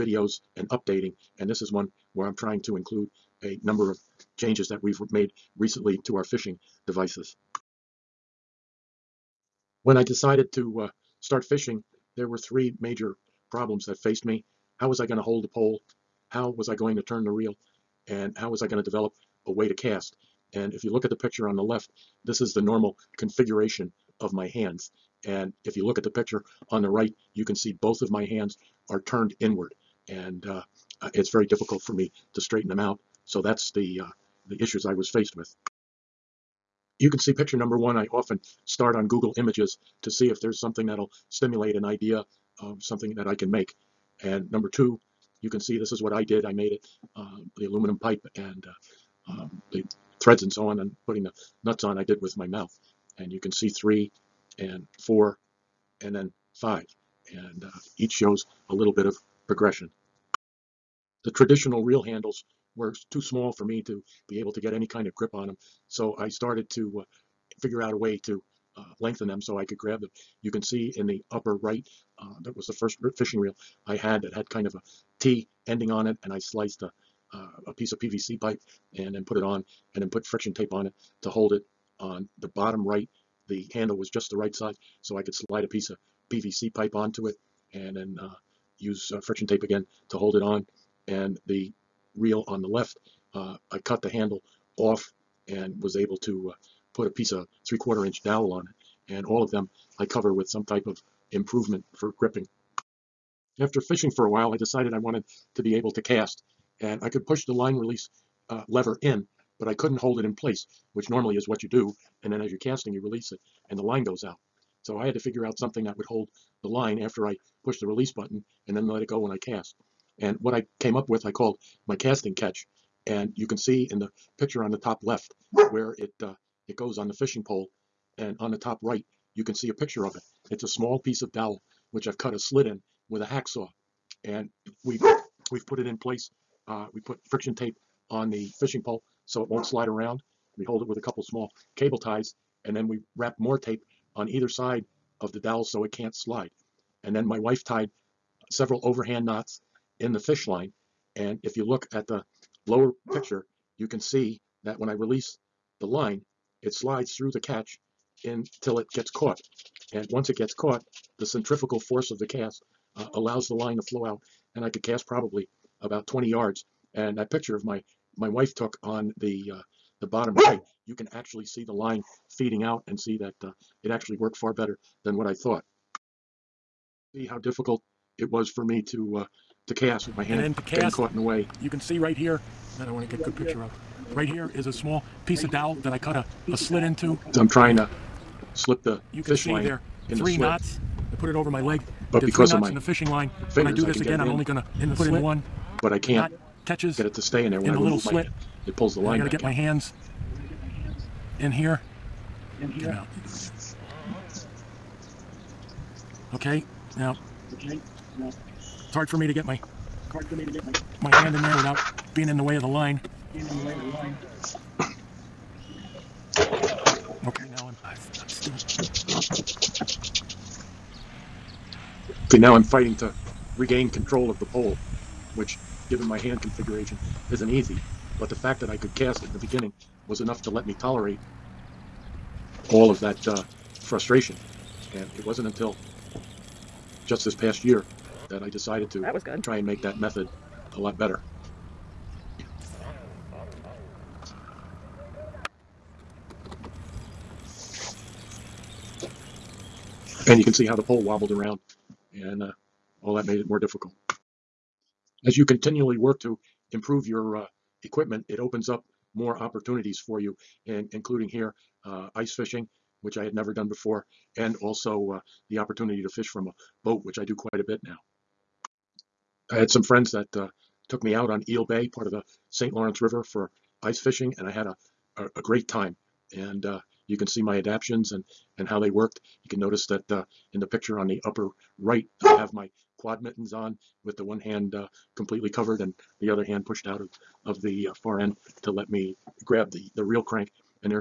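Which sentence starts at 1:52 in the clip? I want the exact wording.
And then as you're casting, you release it and the line goes out.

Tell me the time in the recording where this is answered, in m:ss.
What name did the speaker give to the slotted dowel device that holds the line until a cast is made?
2:01.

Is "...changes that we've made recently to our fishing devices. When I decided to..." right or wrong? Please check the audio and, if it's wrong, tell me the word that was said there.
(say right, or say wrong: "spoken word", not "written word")
right.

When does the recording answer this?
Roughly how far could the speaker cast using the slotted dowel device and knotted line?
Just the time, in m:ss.
2:46.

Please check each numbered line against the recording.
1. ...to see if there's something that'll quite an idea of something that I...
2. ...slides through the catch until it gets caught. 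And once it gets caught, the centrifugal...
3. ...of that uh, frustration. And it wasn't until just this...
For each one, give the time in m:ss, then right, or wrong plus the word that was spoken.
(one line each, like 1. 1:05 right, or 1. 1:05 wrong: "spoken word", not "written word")
1. 0:40 wrong: "stimulate", not "quite"
2. 2:36 right
3. 3:52 right.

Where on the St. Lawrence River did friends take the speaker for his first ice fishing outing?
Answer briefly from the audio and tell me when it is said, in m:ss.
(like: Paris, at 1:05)
Eel Bay, at 4:31.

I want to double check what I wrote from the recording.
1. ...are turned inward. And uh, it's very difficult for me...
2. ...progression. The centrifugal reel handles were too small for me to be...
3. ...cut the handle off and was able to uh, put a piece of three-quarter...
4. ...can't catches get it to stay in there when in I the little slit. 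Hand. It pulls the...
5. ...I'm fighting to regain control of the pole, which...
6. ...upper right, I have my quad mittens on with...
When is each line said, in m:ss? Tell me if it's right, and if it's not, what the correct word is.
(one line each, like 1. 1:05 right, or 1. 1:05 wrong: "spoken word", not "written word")
1. 0:28 right
2. 0:59 wrong: "traditional", not "centrifugal"
3. 1:33 right
4. 3:15 right
5. 3:42 right
6. 4:41 right.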